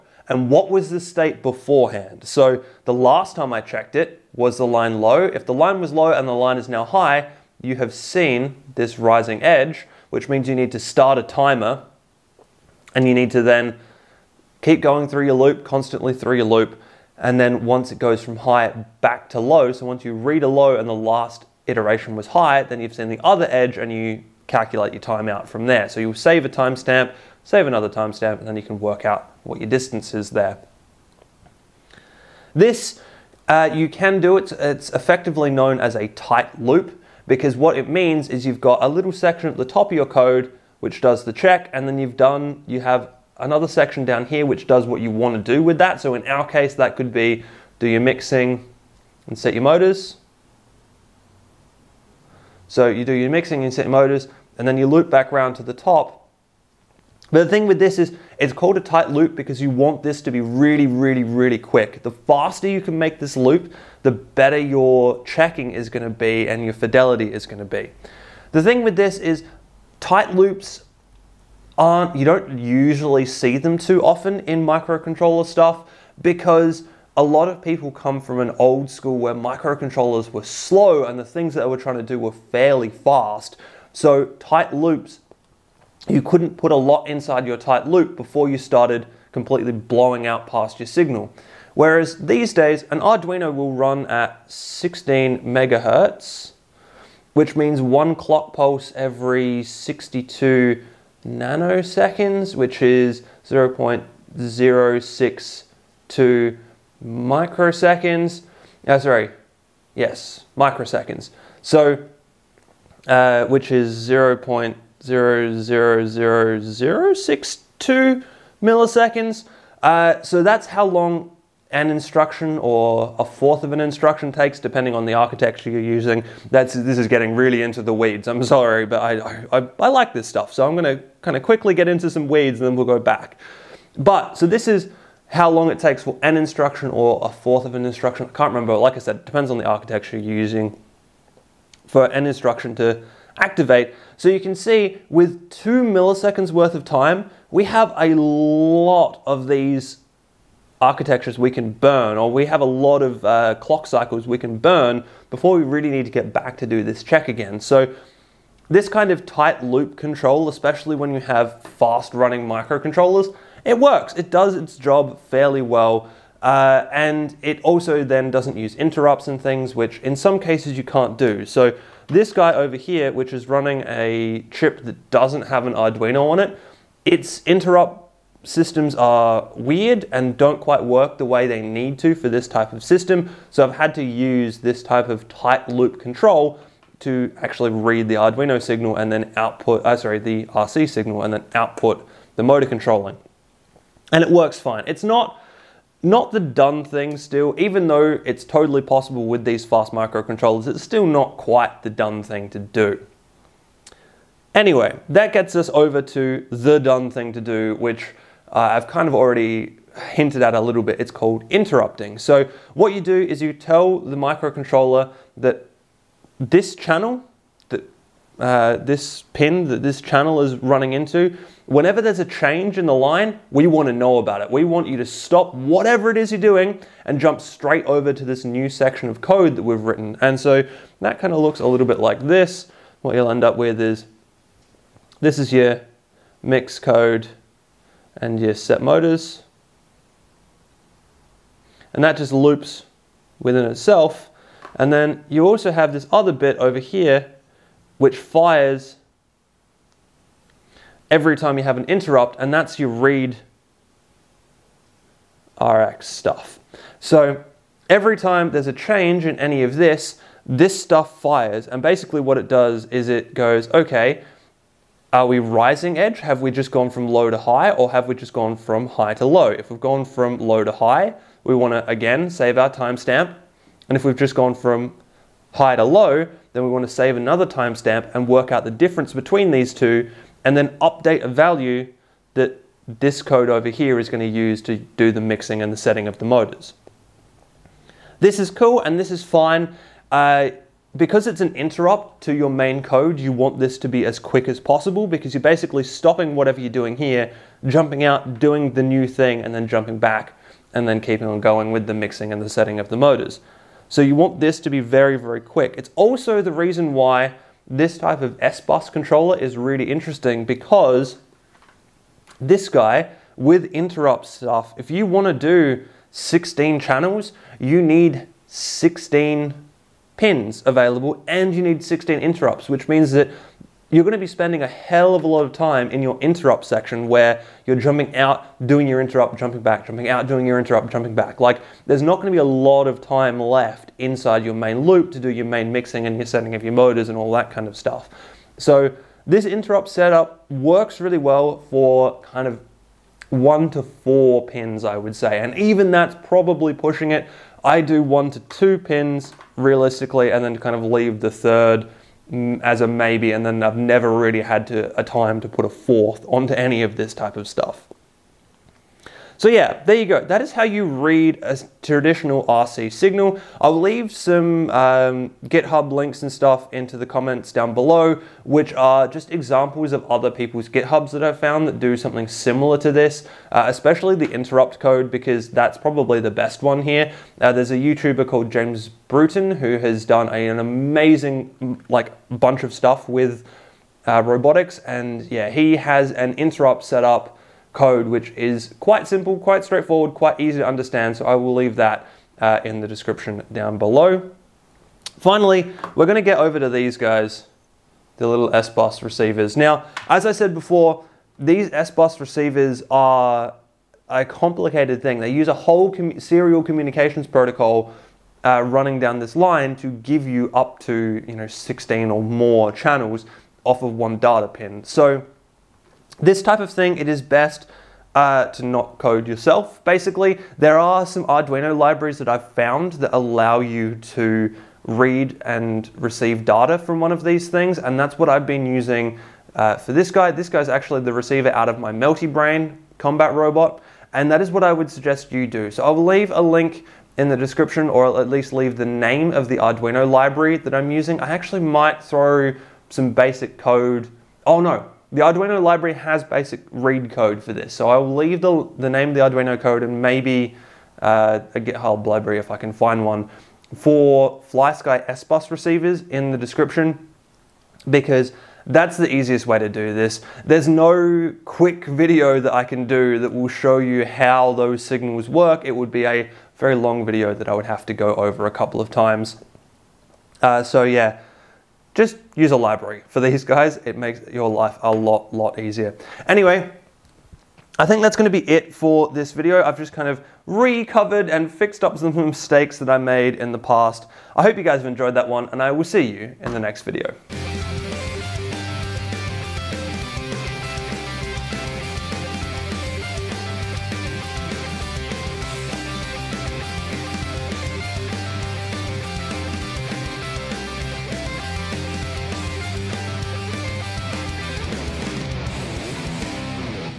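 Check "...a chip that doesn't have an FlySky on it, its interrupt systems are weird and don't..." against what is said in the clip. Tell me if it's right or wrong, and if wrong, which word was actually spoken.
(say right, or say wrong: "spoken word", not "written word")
wrong: "Arduino", not "FlySky".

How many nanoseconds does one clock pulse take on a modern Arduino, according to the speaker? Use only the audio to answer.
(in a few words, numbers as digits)
62 nanoseconds.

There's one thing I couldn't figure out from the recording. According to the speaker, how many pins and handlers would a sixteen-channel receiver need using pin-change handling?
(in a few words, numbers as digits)
16.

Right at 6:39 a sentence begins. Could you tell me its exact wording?
Now, as I said before, these S-Bus receivers are a complicated thing.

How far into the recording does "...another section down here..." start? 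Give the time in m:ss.
0:43.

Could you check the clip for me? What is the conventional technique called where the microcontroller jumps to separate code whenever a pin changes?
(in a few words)
interrupting.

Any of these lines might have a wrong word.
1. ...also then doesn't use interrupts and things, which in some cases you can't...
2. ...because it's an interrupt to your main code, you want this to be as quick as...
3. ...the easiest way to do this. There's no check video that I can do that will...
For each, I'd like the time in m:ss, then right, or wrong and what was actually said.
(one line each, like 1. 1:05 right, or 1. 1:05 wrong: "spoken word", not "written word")
1. 2:47 right
2. 4:50 right
3. 7:38 wrong: "quick", not "check".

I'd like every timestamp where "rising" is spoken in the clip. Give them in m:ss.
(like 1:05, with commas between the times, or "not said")
0:08, 4:25.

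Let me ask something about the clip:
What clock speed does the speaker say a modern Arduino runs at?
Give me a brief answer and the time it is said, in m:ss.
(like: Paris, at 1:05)
16 megahertz, at 1:34.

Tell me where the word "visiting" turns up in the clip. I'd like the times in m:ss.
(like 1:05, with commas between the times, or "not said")
not said.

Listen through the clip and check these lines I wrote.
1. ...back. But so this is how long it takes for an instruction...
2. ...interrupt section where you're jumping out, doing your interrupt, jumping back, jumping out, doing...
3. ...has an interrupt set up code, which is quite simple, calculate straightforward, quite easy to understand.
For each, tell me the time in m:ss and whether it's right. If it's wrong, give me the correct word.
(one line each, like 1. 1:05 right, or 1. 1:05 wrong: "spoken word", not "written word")
1. 2:12 right
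2. 5:26 right
3. 6:25 wrong: "quite", not "calculate".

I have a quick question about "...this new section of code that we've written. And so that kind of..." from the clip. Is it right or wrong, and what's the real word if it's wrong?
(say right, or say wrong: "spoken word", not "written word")
right.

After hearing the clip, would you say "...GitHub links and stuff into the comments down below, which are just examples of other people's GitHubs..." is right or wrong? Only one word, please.
right.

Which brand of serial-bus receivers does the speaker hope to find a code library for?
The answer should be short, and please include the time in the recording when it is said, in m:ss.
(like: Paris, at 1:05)
FlySky, at 7:34.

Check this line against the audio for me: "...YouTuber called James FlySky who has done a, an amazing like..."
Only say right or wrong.
wrong.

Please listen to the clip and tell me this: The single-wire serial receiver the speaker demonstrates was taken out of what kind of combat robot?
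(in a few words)
Melty Brain.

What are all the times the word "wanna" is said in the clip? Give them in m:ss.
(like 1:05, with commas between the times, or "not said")
4:31, 4:36.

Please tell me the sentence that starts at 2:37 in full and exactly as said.
So this kind of tight loop control, especially when you have fast running microcontrollers, it works.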